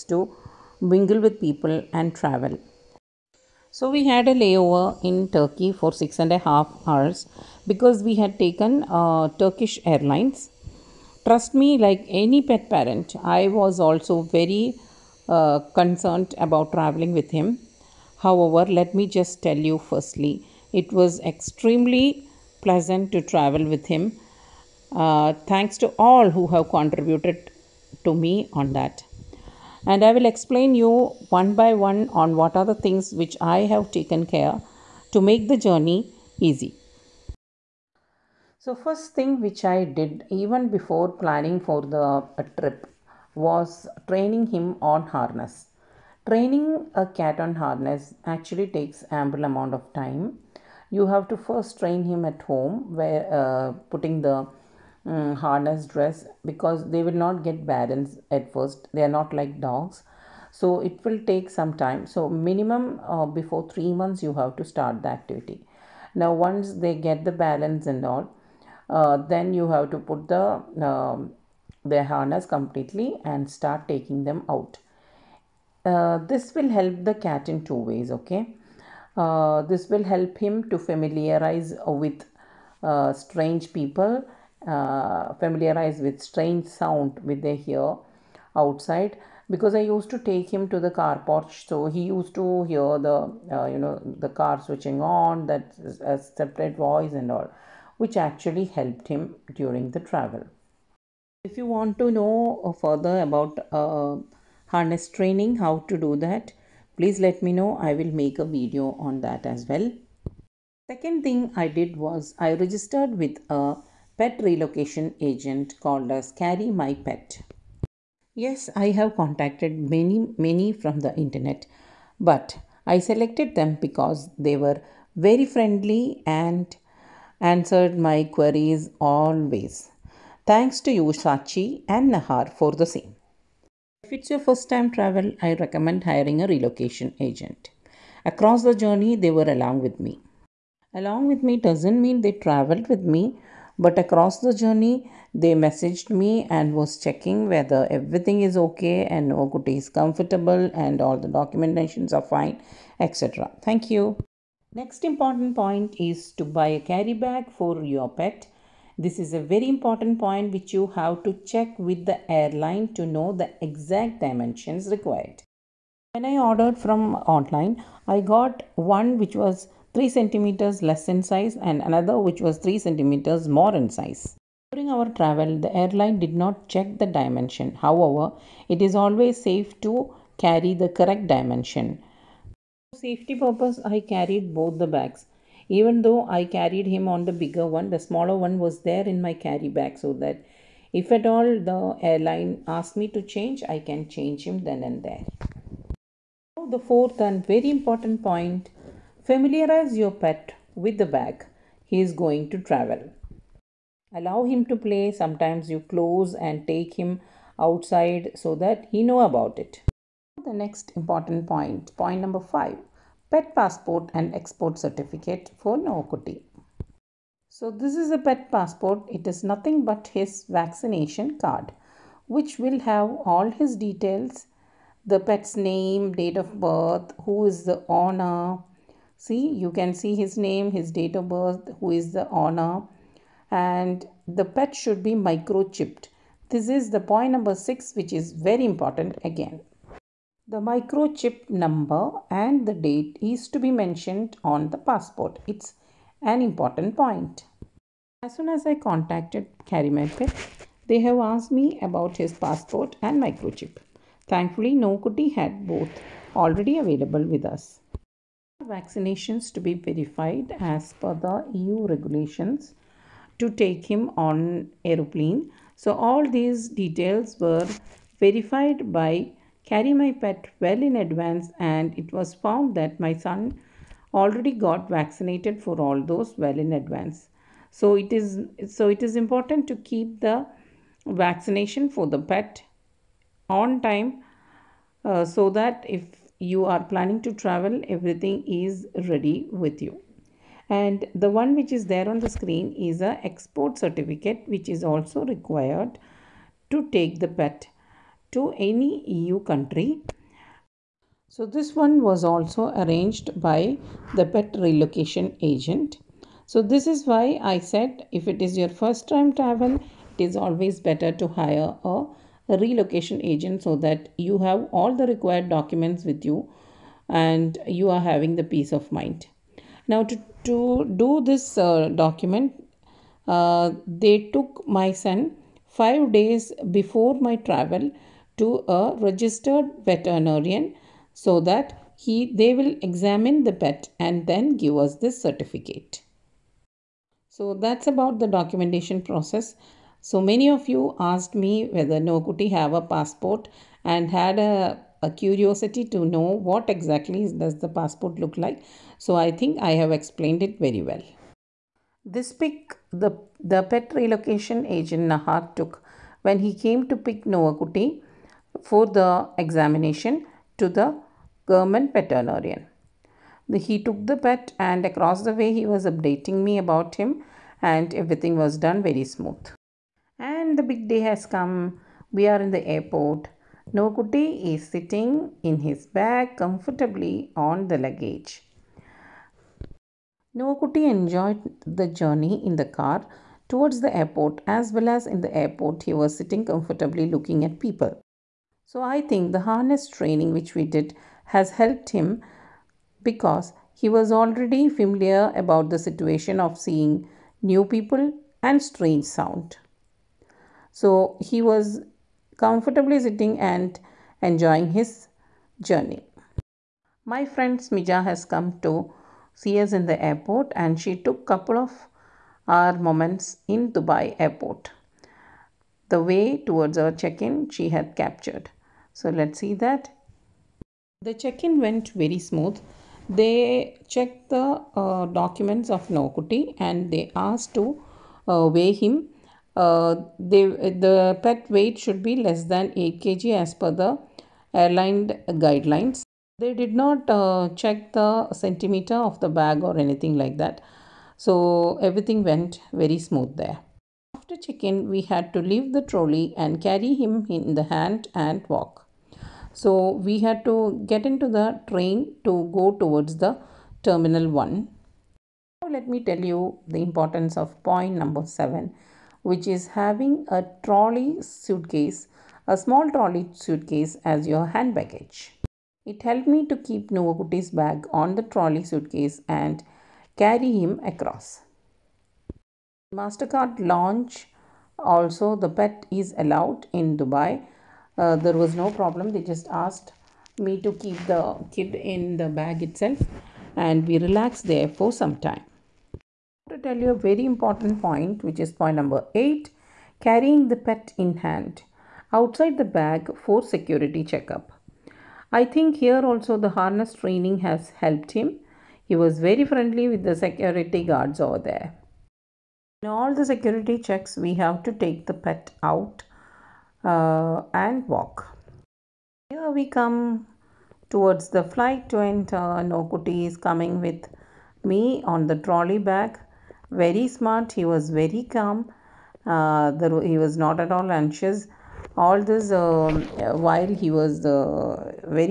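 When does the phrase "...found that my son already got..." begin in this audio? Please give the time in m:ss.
4:32.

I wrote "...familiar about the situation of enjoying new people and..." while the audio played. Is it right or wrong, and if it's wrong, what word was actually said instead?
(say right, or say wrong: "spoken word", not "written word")
wrong: "seeing", not "enjoying".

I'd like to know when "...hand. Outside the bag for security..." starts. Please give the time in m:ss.
8:11.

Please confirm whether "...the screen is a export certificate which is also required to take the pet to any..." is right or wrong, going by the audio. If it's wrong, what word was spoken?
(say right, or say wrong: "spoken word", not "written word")
right.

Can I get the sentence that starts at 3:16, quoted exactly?
Now the fourth and very important point Familiarize your pet with the bag he is going to travel.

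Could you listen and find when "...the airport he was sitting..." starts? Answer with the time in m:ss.
6:25.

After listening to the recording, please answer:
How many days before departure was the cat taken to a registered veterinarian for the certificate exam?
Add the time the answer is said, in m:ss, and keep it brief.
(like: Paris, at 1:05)
5 days, at 5:25.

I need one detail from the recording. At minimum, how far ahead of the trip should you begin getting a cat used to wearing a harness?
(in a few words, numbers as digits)
3 months.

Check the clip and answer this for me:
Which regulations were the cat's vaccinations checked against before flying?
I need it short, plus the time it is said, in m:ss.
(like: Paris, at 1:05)
EU regulations, at 4:21.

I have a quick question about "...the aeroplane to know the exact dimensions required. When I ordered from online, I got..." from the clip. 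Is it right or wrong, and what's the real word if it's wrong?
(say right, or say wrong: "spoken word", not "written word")
wrong: "airline", not "aeroplane".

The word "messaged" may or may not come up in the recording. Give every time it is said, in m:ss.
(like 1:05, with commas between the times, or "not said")
2:25.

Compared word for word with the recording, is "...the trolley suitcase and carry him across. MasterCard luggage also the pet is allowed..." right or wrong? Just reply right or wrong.
wrong.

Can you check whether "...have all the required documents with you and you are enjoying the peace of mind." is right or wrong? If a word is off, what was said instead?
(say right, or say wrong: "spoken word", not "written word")
wrong: "having", not "enjoying".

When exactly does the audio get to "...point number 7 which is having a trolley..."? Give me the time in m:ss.
7:37.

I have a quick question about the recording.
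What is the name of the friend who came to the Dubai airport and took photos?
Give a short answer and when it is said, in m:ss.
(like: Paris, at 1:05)
Smija, at 6:47.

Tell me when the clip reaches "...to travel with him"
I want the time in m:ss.
0:23.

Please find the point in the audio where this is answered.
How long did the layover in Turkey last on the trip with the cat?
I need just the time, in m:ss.
0:05.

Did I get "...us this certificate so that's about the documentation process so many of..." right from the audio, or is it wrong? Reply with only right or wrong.
right.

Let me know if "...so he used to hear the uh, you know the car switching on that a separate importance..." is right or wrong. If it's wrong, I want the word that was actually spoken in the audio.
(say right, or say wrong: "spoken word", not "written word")
wrong: "voice", not "importance".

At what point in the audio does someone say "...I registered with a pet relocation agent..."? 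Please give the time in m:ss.
1:52.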